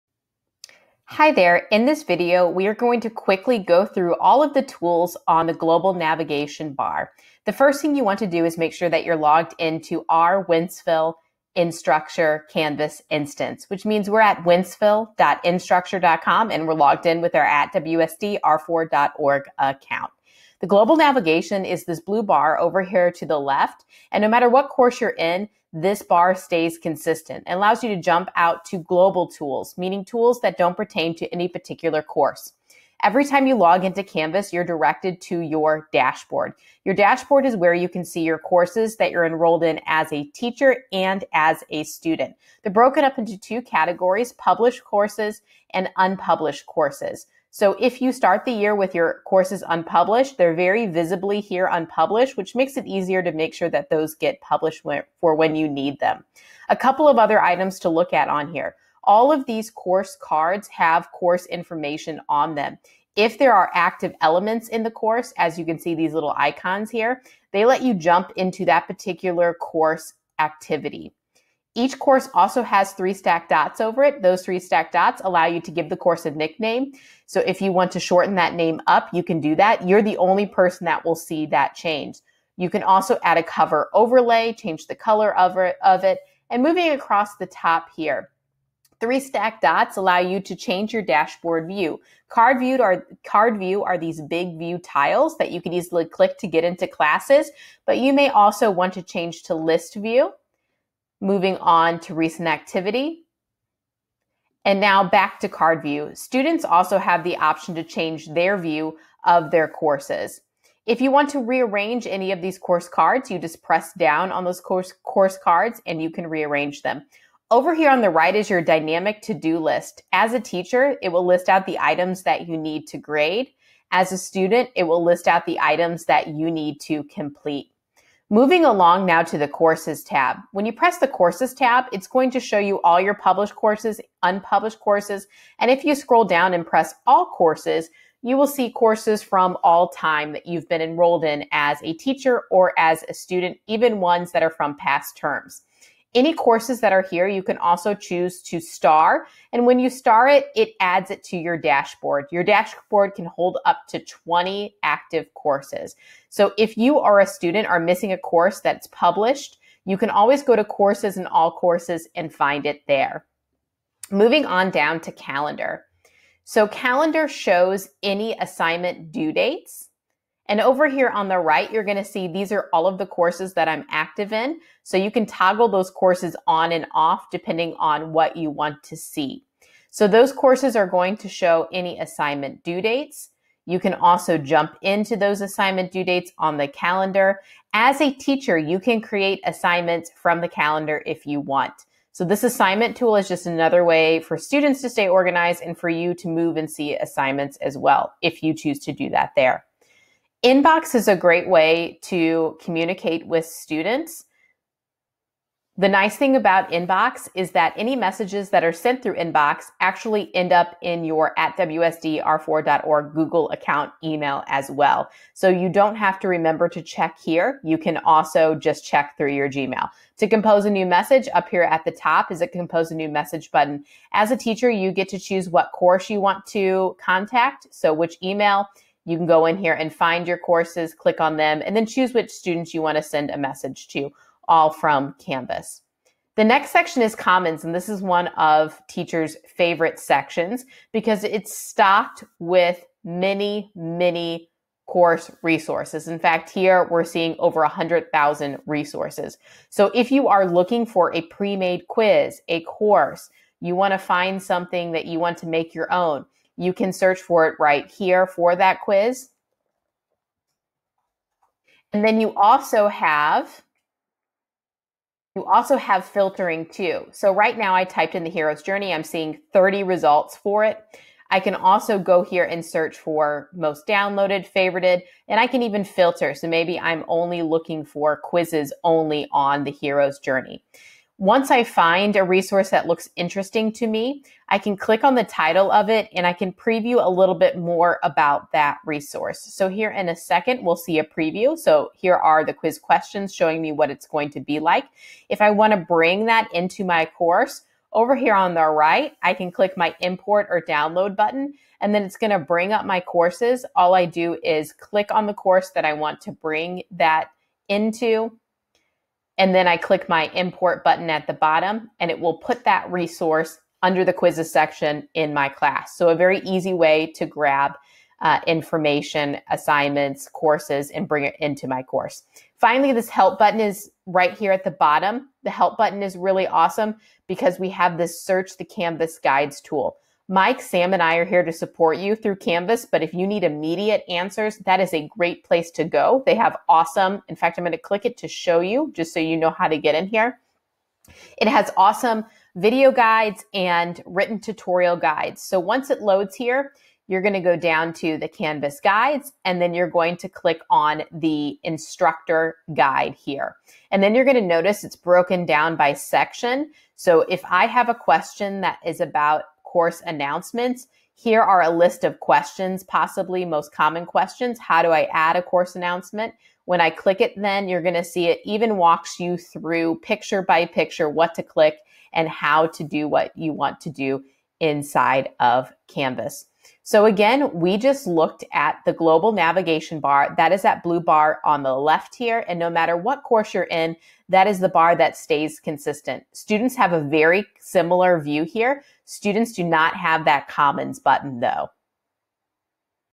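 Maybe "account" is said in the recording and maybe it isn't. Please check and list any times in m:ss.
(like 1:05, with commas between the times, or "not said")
0:19, 3:33.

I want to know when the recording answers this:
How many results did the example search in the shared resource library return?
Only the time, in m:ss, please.
4:29.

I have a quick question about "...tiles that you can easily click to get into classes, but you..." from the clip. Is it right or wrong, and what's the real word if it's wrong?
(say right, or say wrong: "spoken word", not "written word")
right.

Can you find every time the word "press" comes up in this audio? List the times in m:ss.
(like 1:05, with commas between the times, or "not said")
1:53, 2:10, 2:16.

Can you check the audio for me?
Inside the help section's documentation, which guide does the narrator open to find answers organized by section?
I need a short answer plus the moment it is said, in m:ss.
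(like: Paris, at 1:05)
instructor guide, at 5:51.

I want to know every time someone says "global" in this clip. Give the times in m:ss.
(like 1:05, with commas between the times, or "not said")
0:05, 0:20, 0:28, 6:18.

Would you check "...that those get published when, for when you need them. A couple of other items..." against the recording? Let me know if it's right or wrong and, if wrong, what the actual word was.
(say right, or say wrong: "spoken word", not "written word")
right.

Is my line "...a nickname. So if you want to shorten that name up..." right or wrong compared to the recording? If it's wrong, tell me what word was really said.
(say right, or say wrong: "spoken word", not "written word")
right.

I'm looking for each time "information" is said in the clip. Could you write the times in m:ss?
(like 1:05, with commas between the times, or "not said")
1:01, 5:18.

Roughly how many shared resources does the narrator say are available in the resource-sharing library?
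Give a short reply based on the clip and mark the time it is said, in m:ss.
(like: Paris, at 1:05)
over 100,000, at 4:07.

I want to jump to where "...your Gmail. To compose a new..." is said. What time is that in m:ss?
3:39.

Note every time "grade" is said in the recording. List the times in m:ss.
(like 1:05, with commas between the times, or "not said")
2:02.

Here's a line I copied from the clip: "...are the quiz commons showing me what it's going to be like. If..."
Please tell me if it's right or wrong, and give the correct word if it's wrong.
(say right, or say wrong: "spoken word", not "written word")
wrong: "questions", not "commons".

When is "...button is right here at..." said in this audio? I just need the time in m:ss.
5:23.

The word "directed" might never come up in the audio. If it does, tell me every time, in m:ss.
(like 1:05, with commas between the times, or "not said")
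0:34.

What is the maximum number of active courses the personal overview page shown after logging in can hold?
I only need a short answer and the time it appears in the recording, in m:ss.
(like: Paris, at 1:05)
20, at 2:34.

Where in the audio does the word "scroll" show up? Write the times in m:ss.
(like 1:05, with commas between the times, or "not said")
2:15.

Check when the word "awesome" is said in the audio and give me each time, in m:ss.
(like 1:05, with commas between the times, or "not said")
5:26, 5:36, 5:41.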